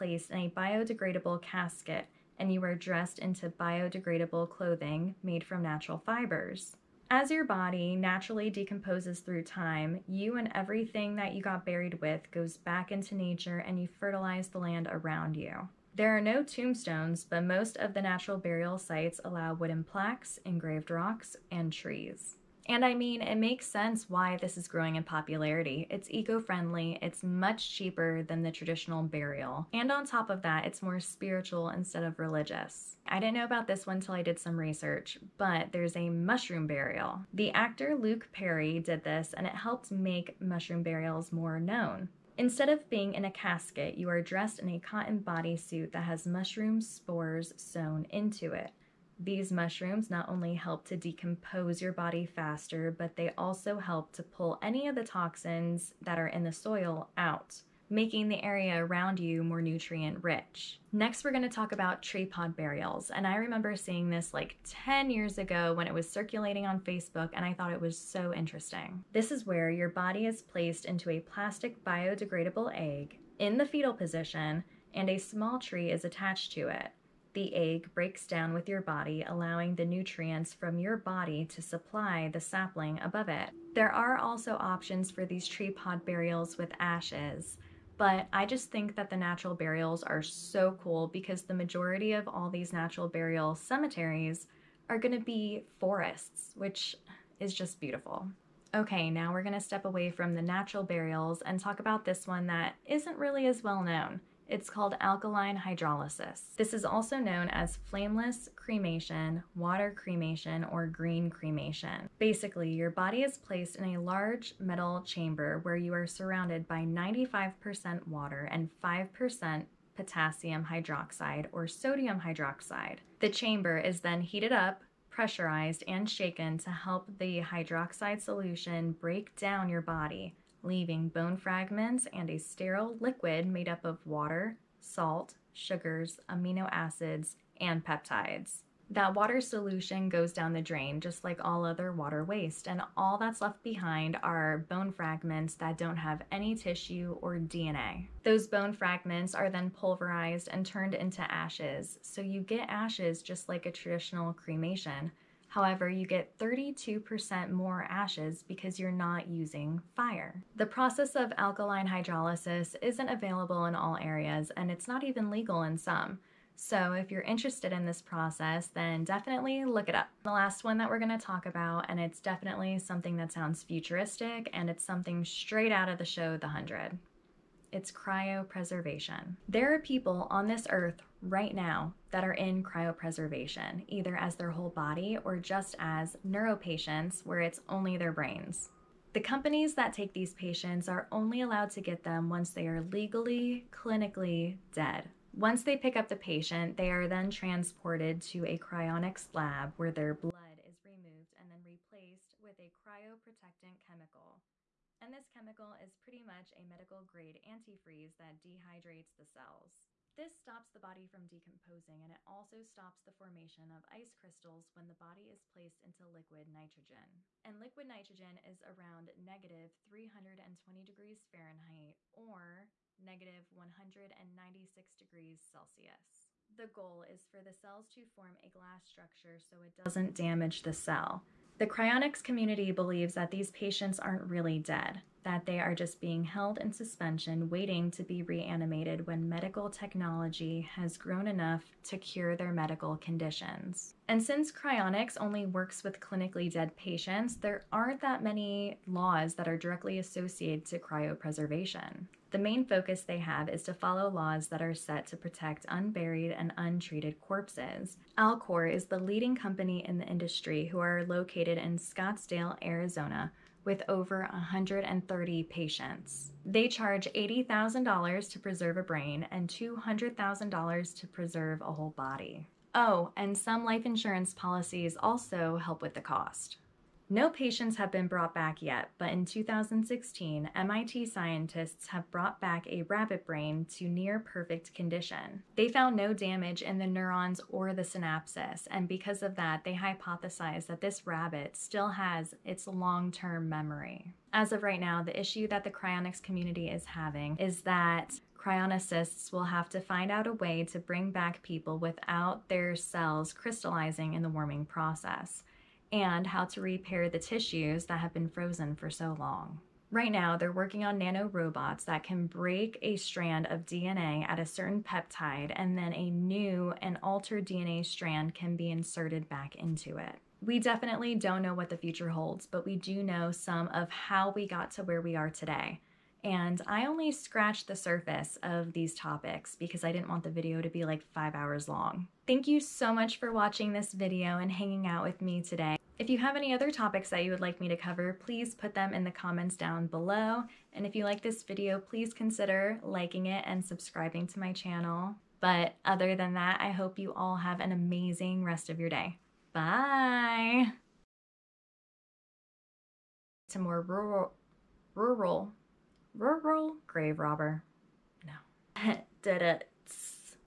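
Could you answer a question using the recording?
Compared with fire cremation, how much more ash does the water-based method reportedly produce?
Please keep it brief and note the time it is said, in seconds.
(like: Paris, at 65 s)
32%, at 156 s.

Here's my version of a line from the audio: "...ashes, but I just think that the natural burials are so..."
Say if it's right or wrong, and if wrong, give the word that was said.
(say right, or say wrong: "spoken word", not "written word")
right.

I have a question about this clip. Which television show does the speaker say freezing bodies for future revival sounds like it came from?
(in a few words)
The 100.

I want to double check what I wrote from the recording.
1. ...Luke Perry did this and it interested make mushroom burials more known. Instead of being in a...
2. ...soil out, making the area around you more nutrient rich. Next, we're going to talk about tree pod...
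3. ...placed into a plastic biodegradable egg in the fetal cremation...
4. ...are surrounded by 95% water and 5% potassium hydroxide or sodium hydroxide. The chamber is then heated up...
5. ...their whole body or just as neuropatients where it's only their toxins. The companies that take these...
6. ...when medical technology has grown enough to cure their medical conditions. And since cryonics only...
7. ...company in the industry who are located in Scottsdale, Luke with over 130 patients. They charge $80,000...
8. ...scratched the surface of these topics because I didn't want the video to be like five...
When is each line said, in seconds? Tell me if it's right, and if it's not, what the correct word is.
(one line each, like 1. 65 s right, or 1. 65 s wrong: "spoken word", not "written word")
1. 37 s wrong: "helped", not "interested"
2. 56 s right
3. 70 s wrong: "position", not "cremation"
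4. 115 s right
5. 184 s wrong: "brains", not "toxins"
6. 239 s right
7. 259 s wrong: "Arizona", not "Luke"
8. 327 s right.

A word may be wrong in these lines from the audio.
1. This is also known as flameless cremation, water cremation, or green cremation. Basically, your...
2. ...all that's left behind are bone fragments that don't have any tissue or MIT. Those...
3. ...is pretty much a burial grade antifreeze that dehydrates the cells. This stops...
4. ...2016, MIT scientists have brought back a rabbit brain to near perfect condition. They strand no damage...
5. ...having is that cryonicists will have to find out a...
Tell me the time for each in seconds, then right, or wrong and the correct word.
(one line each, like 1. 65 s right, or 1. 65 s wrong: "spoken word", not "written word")
1. 106 s right
2. 142 s wrong: "DNA", not "MIT"
3. 205 s wrong: "medical", not "burial"
4. 279 s wrong: "found", not "strand"
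5. 296 s right.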